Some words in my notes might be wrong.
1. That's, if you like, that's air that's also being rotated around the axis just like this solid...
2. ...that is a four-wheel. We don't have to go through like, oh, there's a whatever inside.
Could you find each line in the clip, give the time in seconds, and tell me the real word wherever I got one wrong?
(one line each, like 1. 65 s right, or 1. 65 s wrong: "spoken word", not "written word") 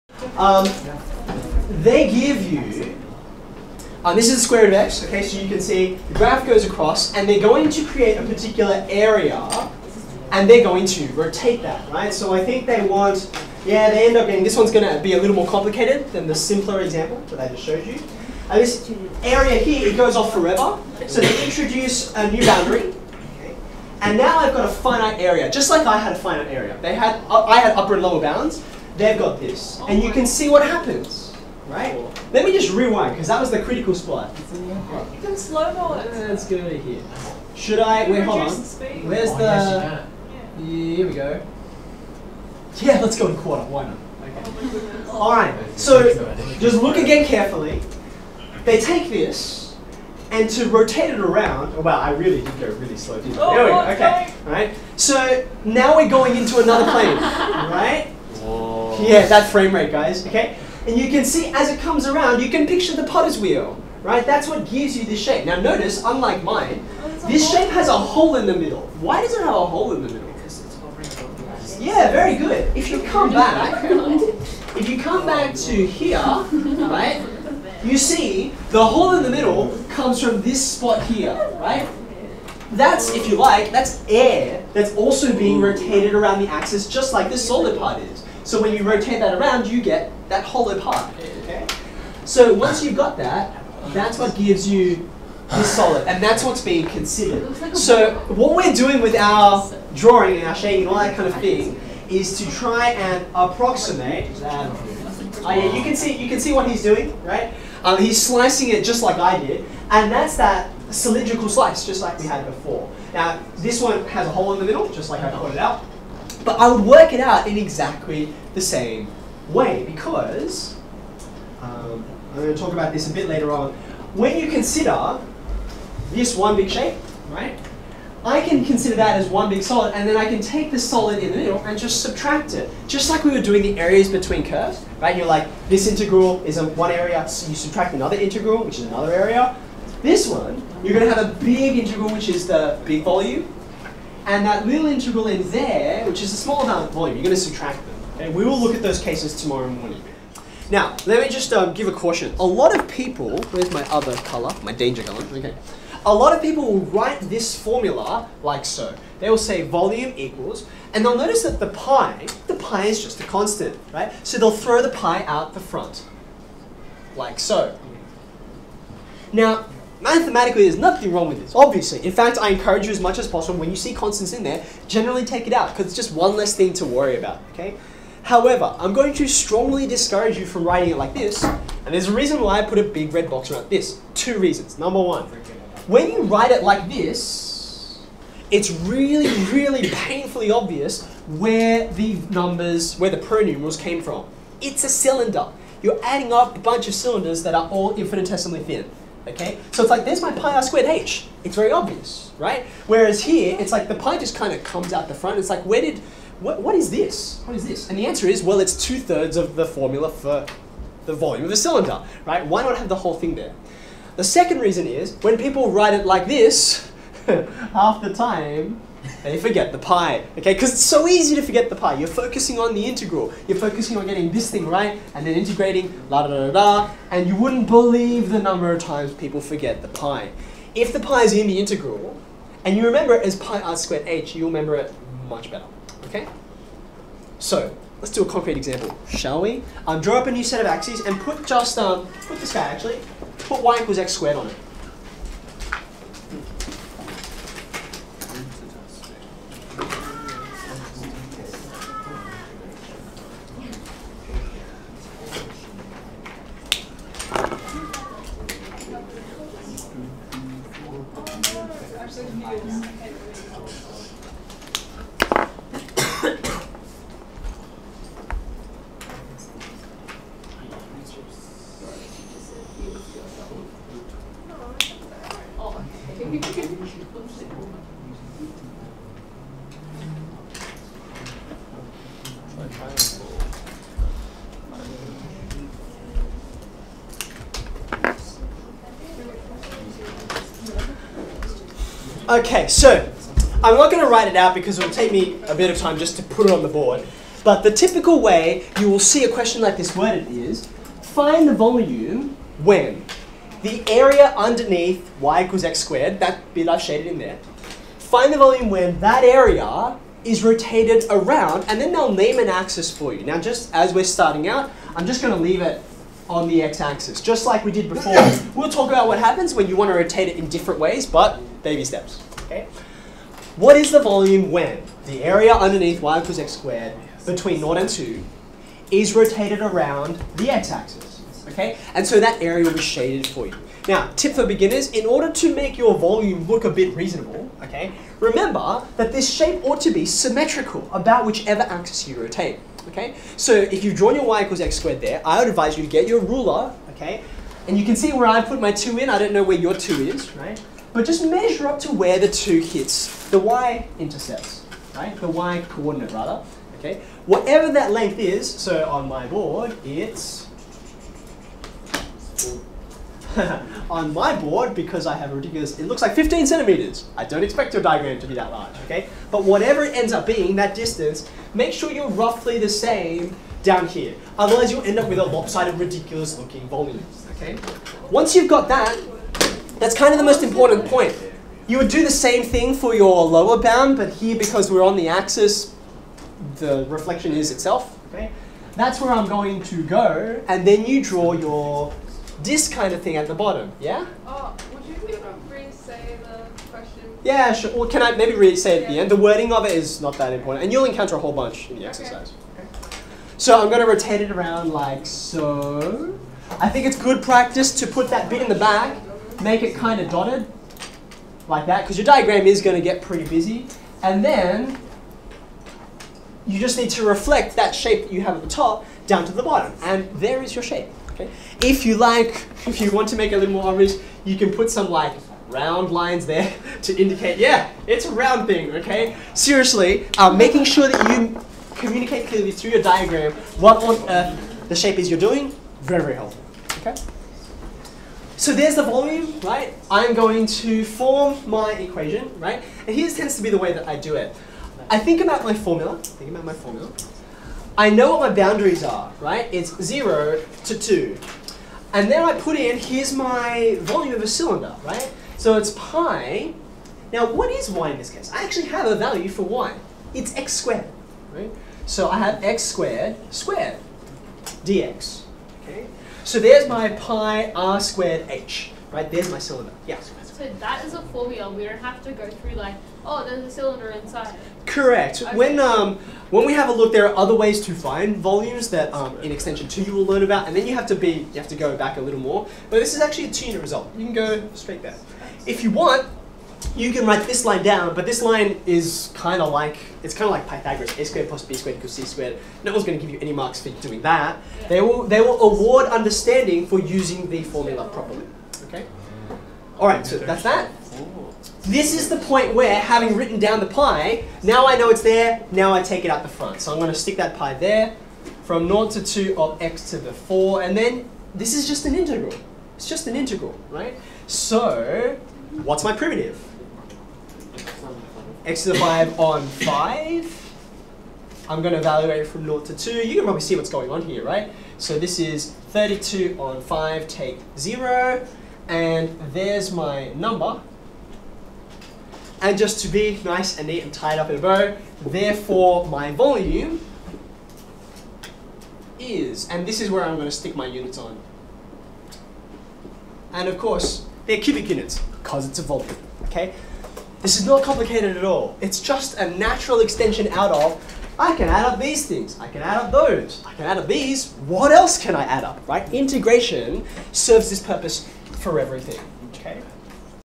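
1. 82 s right
2. 470 s wrong: "cylinder", not "whatever".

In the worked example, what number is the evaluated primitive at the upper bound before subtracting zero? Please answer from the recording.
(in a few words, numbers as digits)
32 on 5.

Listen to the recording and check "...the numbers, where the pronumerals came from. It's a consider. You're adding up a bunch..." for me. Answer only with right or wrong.
wrong.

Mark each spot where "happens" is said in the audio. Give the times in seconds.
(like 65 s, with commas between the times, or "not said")
30 s, 319 s.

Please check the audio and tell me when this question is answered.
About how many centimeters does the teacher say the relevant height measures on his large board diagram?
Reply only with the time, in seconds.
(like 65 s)
366 s.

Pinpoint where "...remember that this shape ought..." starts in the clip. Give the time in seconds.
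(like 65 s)
338 s.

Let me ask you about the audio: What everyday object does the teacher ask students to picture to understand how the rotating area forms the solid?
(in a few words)
potter's wheel.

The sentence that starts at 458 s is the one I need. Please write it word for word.
I actually have a value for y.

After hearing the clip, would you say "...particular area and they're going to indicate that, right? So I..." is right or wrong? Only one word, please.
wrong.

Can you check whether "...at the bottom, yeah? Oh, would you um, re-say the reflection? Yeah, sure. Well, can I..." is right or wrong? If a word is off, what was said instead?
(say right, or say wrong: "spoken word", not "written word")
wrong: "question", not "reflection".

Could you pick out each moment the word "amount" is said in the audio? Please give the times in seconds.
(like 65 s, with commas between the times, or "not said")
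146 s.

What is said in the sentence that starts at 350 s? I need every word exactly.
But just measure up to where the 2 hits the y-intercept, right?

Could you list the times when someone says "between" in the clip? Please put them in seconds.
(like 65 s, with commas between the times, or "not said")
134 s, 327 s.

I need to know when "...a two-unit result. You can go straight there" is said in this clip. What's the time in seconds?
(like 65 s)
483 s.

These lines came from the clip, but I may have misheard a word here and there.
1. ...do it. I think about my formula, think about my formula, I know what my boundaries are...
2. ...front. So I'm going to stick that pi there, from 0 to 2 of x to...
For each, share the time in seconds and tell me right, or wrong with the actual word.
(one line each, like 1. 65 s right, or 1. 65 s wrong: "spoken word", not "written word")
1. 443 s right
2. 506 s right.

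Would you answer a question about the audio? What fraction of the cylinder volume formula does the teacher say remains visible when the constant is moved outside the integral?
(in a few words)
two thirds.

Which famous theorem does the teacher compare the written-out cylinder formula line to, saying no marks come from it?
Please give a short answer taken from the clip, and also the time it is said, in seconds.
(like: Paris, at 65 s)
Pythagoras, at 490 s.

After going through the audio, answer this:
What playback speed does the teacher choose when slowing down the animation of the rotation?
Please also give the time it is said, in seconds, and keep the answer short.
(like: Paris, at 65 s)
quarter, at 43 s.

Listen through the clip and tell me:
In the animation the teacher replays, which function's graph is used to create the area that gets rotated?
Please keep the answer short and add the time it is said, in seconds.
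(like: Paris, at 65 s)
square root of x, at 4 s.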